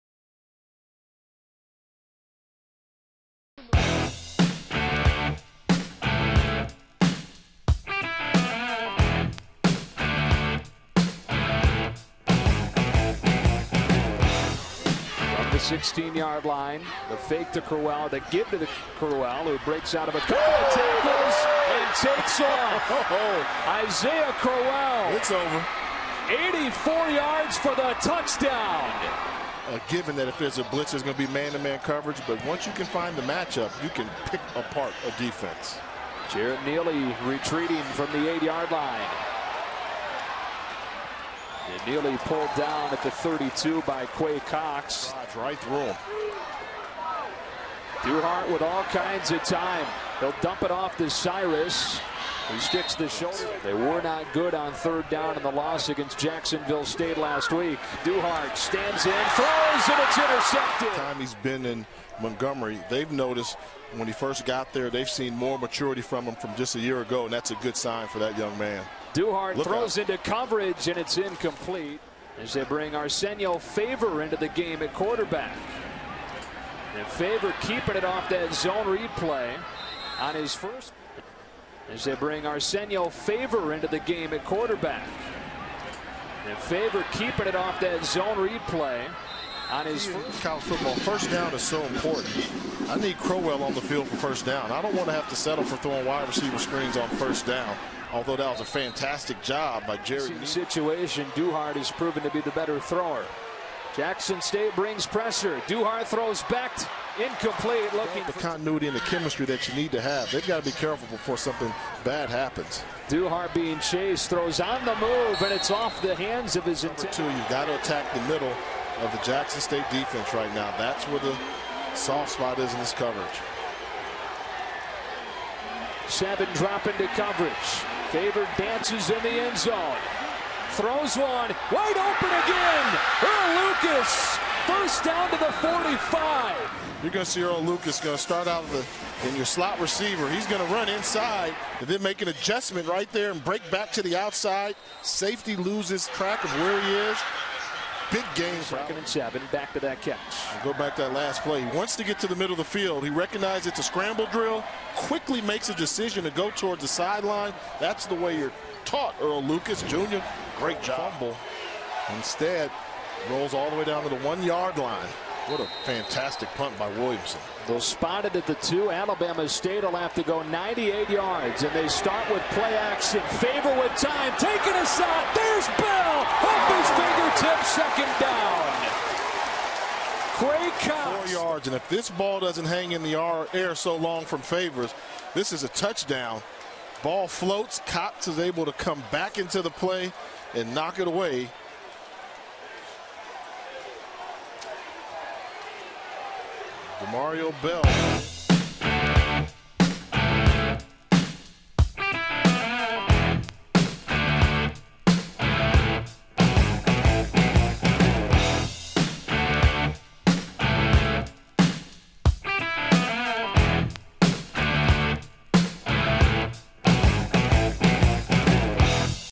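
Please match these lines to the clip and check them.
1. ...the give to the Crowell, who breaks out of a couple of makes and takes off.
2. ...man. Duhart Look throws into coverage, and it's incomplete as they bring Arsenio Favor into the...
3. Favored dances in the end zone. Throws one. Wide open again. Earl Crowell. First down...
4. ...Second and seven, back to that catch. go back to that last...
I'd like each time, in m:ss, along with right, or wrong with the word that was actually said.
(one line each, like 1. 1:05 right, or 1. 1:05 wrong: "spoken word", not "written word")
1. 0:18 wrong: "tackles", not "makes"
2. 1:08 right
3. 2:08 wrong: "Lucas", not "Crowell"
4. 2:28 right.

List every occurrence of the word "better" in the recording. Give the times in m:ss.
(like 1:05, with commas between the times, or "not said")
1:42.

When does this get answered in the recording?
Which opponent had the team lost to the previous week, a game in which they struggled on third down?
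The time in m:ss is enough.
0:56.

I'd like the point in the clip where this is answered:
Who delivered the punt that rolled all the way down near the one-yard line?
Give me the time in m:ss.
2:46.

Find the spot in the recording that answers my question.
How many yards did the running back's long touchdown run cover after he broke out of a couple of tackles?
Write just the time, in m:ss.
0:26.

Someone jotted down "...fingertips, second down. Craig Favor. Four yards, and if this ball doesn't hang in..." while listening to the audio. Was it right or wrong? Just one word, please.
wrong.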